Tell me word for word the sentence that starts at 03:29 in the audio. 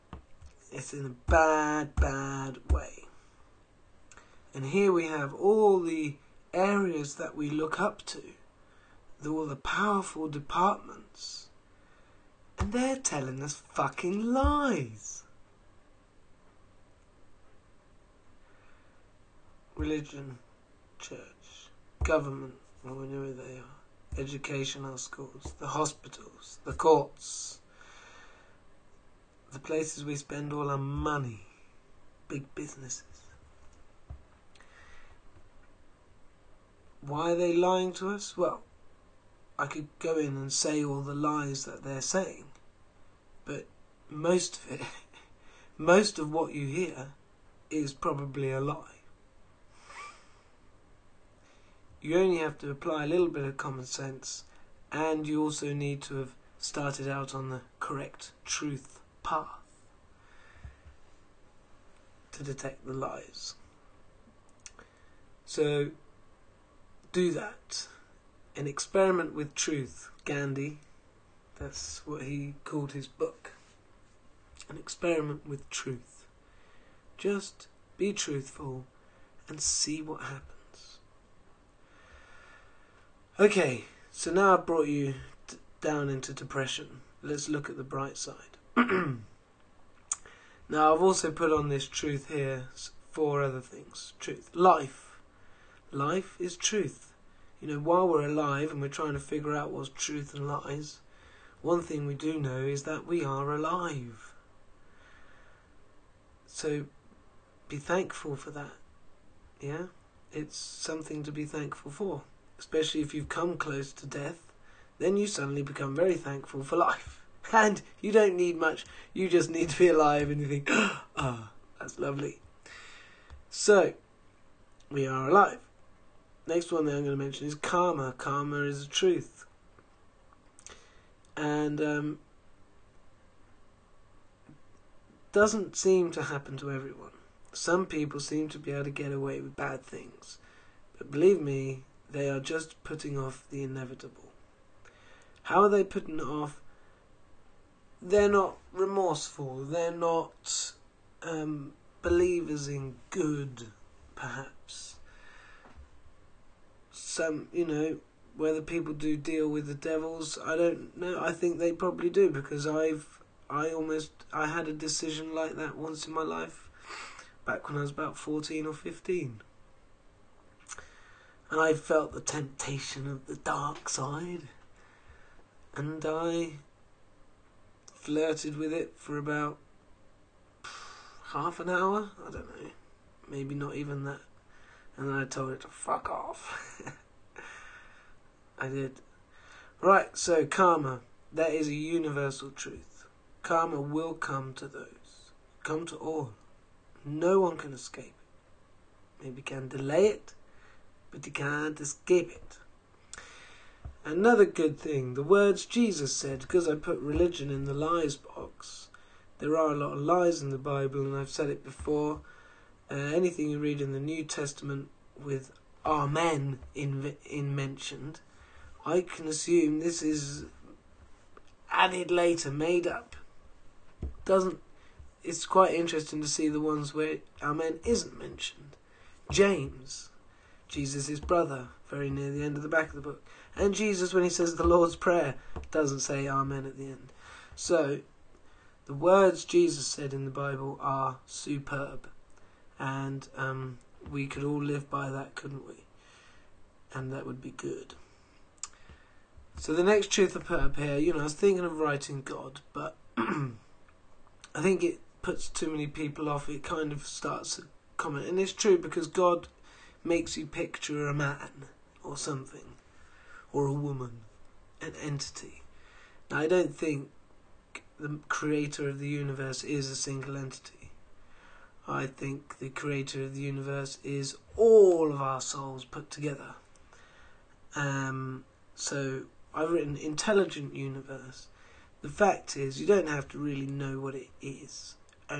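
There are a lot of lies in the Bible, and I've said it before.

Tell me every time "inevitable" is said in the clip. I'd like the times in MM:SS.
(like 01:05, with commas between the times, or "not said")
02:23.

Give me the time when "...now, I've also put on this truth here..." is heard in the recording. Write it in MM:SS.
01:28.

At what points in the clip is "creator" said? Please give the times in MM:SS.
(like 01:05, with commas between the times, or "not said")
04:28, 04:32.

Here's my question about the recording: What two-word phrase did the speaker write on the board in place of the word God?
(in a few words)
Intelligent universe.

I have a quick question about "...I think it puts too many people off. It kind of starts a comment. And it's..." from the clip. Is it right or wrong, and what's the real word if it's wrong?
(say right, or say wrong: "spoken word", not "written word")
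right.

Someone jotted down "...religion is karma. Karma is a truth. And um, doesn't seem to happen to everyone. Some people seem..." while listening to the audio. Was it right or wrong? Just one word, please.
wrong.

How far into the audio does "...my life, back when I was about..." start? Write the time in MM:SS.
02:46.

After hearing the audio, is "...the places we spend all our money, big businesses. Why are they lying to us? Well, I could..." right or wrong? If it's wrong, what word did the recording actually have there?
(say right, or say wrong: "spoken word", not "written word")
right.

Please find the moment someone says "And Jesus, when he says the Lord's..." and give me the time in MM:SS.
03:53.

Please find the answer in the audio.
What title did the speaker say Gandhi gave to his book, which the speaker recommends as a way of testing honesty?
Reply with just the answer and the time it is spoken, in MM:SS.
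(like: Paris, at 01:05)
An experiment with truth, at 01:14.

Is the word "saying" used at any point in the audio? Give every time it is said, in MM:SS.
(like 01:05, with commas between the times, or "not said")
00:42.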